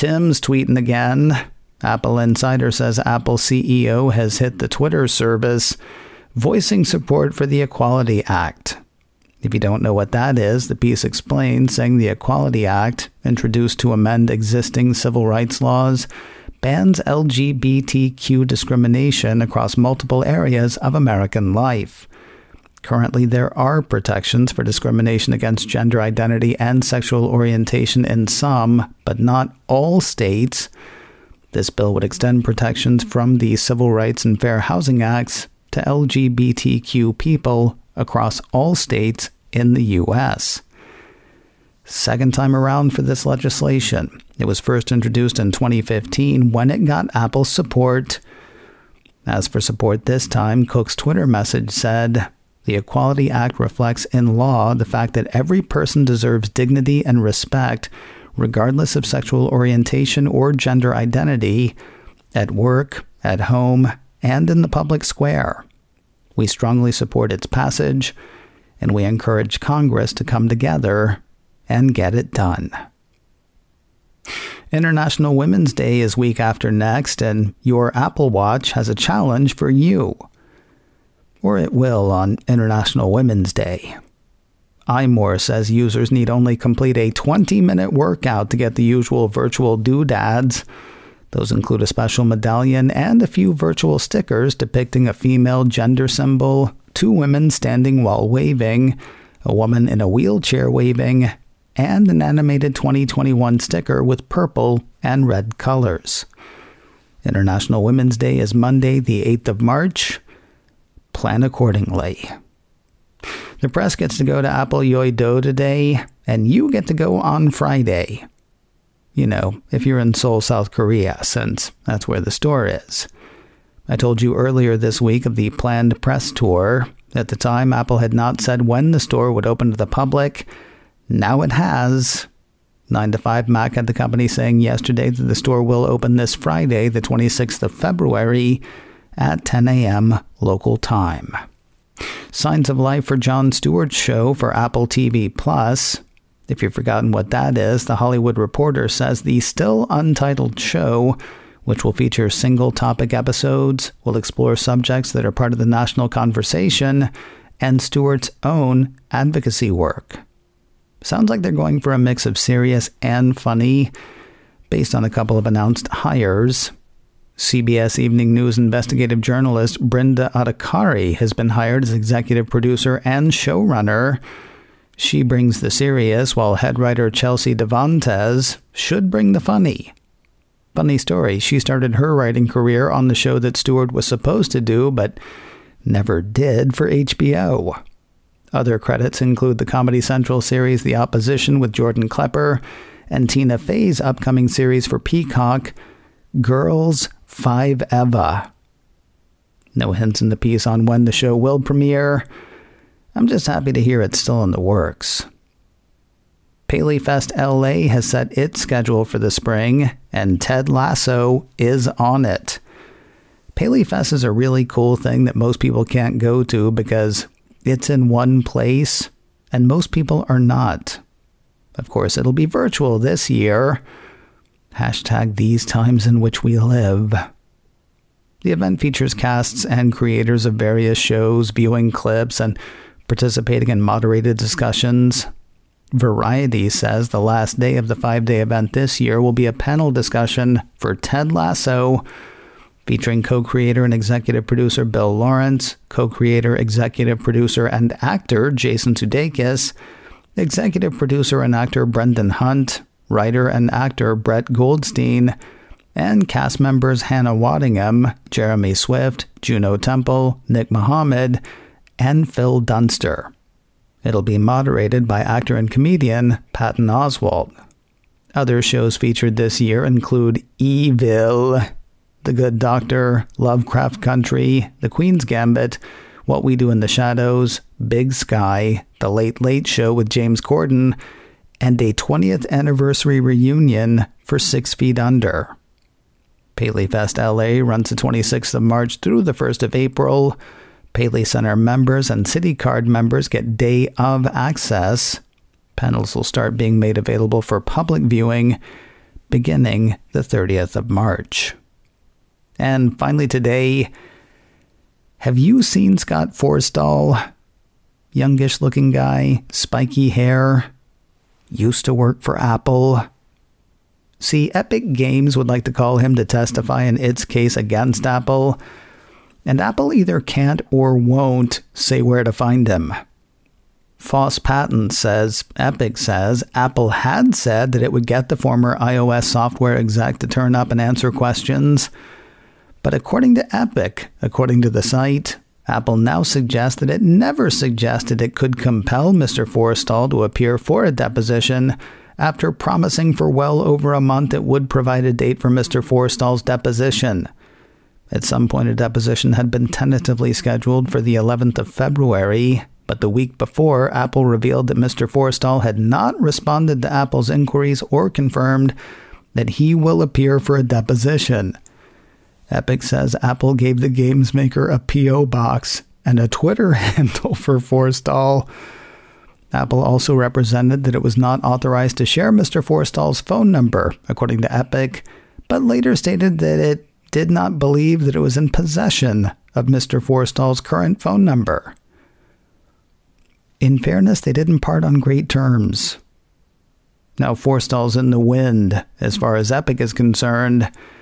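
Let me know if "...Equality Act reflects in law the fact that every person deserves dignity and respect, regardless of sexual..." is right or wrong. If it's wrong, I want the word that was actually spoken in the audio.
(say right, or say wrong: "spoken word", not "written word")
right.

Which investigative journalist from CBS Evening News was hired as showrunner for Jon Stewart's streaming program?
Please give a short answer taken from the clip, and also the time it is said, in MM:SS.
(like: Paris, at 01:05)
Brinda Adhikari, at 02:49.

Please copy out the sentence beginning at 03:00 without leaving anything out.
Funny story, she started her writing career on the show that Stewart was supposed to do, but never did for HBO.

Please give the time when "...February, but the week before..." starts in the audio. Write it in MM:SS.
05:51.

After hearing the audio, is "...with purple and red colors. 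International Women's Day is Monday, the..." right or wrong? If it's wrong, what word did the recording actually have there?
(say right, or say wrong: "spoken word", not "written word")
right.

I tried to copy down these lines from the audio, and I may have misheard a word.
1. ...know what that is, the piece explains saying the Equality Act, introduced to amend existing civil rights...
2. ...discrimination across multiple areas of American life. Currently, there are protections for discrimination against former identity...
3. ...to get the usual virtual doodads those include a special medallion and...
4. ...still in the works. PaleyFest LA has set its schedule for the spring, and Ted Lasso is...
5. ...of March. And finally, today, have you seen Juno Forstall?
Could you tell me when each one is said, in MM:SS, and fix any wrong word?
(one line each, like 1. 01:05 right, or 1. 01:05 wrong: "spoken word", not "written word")
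1. 00:09 right
2. 00:18 wrong: "gender", not "former"
3. 01:28 right
4. 03:24 right
5. 05:00 wrong: "Scott", not "Juno".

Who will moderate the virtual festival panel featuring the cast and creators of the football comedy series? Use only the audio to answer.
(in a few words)
Patton Oswalt.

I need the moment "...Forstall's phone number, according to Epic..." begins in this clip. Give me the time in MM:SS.
06:12.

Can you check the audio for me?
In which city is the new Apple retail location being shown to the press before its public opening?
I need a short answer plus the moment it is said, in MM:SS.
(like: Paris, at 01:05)
Seoul, at 02:00.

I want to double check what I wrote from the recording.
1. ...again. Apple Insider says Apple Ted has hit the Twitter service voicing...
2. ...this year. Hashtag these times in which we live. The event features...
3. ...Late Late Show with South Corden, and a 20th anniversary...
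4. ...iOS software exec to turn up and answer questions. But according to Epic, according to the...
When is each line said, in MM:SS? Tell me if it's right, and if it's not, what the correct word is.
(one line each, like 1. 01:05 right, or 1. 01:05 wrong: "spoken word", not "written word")
1. 00:00 wrong: "CEO", not "Ted"
2. 03:42 right
3. 04:39 wrong: "James", not "South"
4. 05:28 right.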